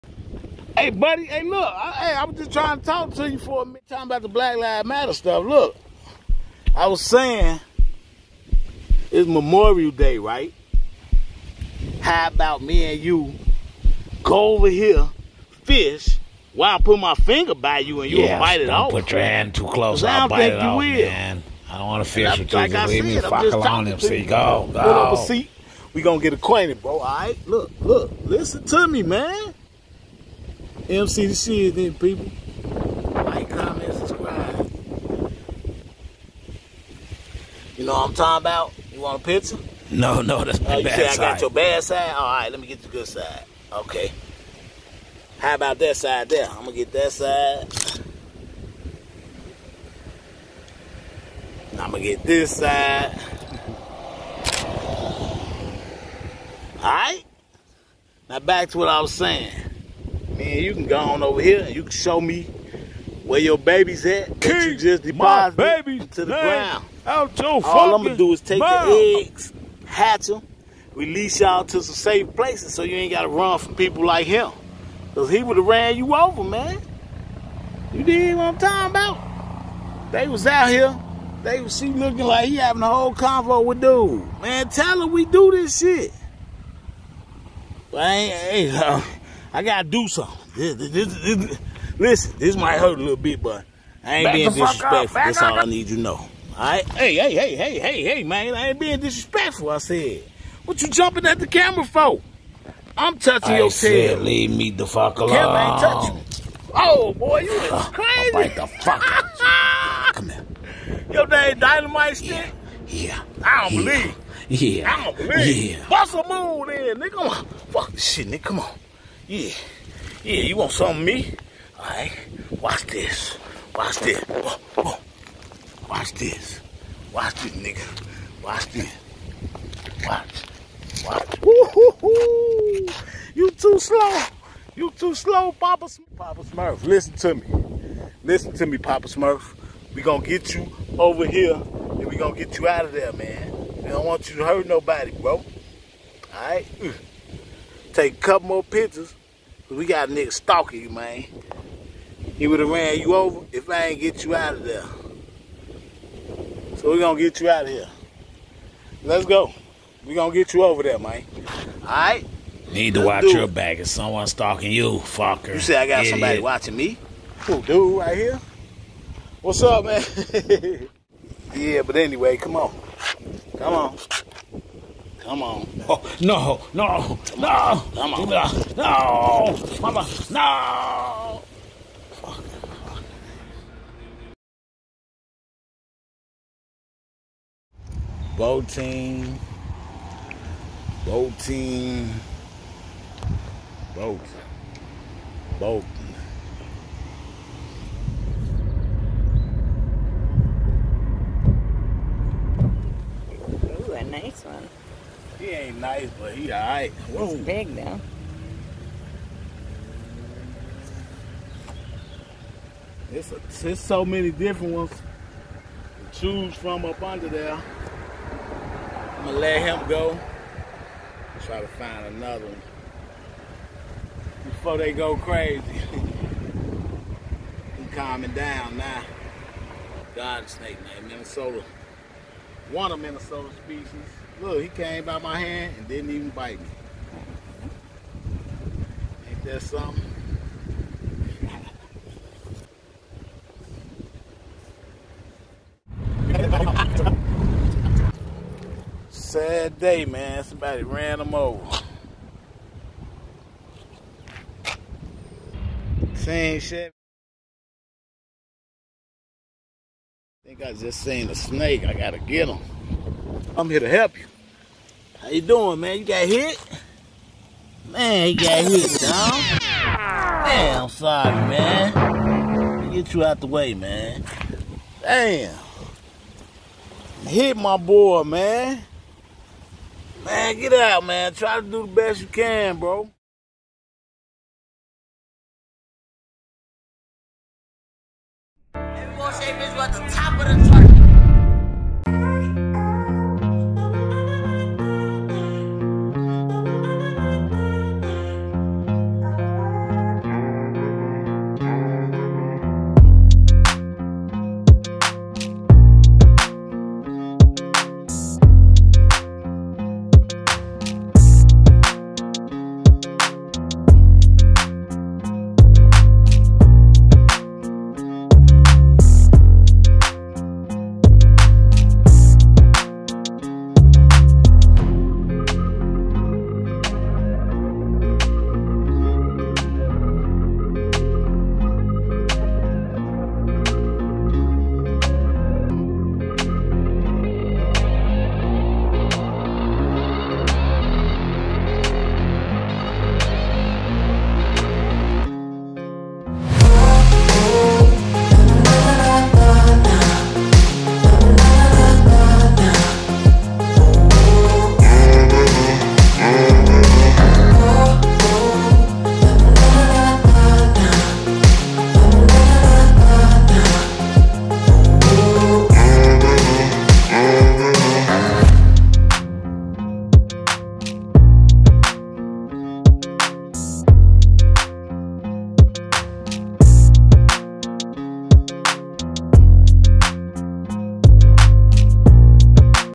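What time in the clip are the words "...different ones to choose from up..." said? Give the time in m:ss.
3:34.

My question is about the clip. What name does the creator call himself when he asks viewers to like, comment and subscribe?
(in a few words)
MC da shiznit.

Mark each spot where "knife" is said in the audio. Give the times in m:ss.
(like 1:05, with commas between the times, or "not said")
not said.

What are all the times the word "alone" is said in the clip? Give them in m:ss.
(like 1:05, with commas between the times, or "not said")
0:23, 1:45.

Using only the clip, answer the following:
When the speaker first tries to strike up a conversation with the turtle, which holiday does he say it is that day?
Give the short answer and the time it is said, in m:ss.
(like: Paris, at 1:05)
Memorial Day, at 0:09.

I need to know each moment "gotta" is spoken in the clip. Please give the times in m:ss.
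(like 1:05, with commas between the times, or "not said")
1:13, 1:29, 4:21.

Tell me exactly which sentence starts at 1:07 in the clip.
Out your All I'm gonna do is take mouth.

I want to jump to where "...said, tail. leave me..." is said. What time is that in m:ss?
1:43.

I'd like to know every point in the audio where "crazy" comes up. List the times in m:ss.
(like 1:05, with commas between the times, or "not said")
1:47, 3:45.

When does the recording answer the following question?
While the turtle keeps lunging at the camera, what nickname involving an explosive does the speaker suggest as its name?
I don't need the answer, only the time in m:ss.
1:51.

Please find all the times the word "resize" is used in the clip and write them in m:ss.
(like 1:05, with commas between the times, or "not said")
not said.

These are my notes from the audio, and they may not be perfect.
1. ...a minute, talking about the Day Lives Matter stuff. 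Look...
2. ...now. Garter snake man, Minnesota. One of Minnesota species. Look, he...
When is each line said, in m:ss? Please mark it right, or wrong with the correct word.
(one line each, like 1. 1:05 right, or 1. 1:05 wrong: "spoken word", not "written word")
1. 0:03 wrong: "Black", not "Day"
2. 3:48 right.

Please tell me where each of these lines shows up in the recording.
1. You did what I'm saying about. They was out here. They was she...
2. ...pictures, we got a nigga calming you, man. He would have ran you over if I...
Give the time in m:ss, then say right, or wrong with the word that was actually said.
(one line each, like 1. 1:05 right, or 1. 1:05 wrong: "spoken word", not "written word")
1. 1:17 wrong: "talking", not "saying"
2. 2:28 wrong: "stalking", not "calming".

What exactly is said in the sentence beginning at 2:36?
So we gonna get you out of here.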